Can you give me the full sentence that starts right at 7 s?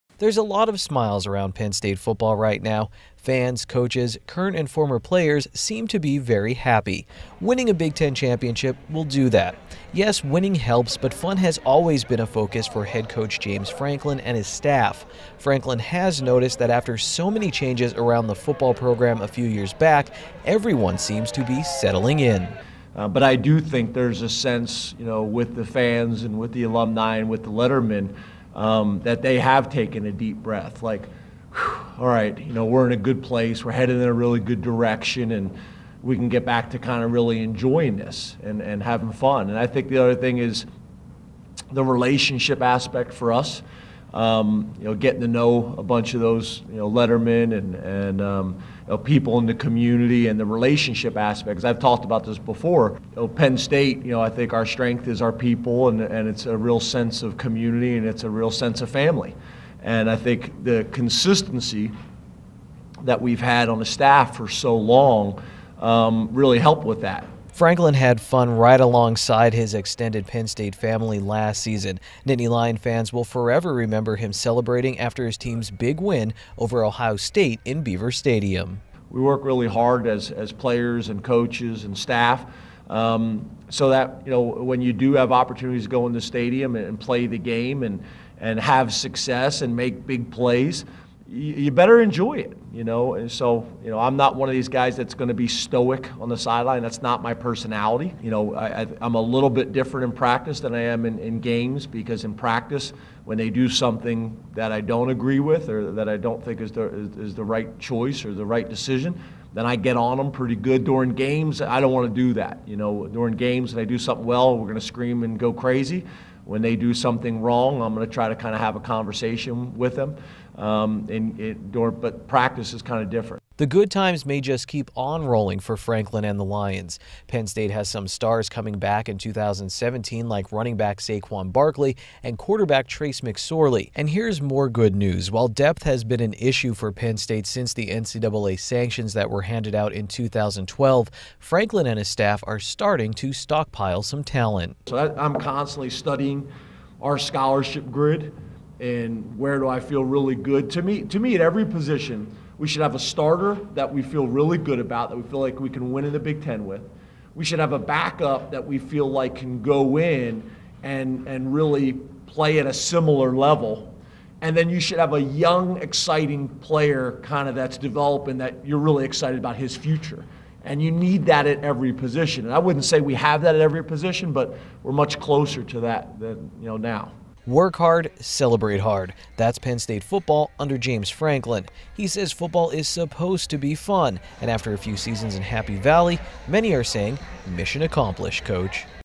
Winning a Big Ten championship will do that.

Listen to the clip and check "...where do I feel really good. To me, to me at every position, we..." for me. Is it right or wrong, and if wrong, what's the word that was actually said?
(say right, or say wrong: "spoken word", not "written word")
right.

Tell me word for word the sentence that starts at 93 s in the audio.
And so, you know, I'm not one of these guys that's going to be stoic on the sideline.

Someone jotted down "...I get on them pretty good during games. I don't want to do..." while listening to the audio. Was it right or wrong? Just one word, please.
right.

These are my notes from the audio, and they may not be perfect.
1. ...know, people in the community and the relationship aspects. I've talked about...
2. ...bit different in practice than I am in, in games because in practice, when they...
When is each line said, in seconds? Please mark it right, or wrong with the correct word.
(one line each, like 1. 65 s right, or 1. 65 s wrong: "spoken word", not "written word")
1. 48 s right
2. 99 s right.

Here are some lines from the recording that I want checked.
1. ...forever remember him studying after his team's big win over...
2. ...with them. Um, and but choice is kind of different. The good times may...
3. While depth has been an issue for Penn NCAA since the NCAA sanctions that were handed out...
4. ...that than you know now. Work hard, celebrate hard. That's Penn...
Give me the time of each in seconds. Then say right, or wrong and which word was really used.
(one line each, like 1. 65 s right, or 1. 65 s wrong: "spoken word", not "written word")
1. 73 s wrong: "celebrating", not "studying"
2. 119 s wrong: "practice", not "choice"
3. 135 s wrong: "State", not "NCAA"
4. 175 s right.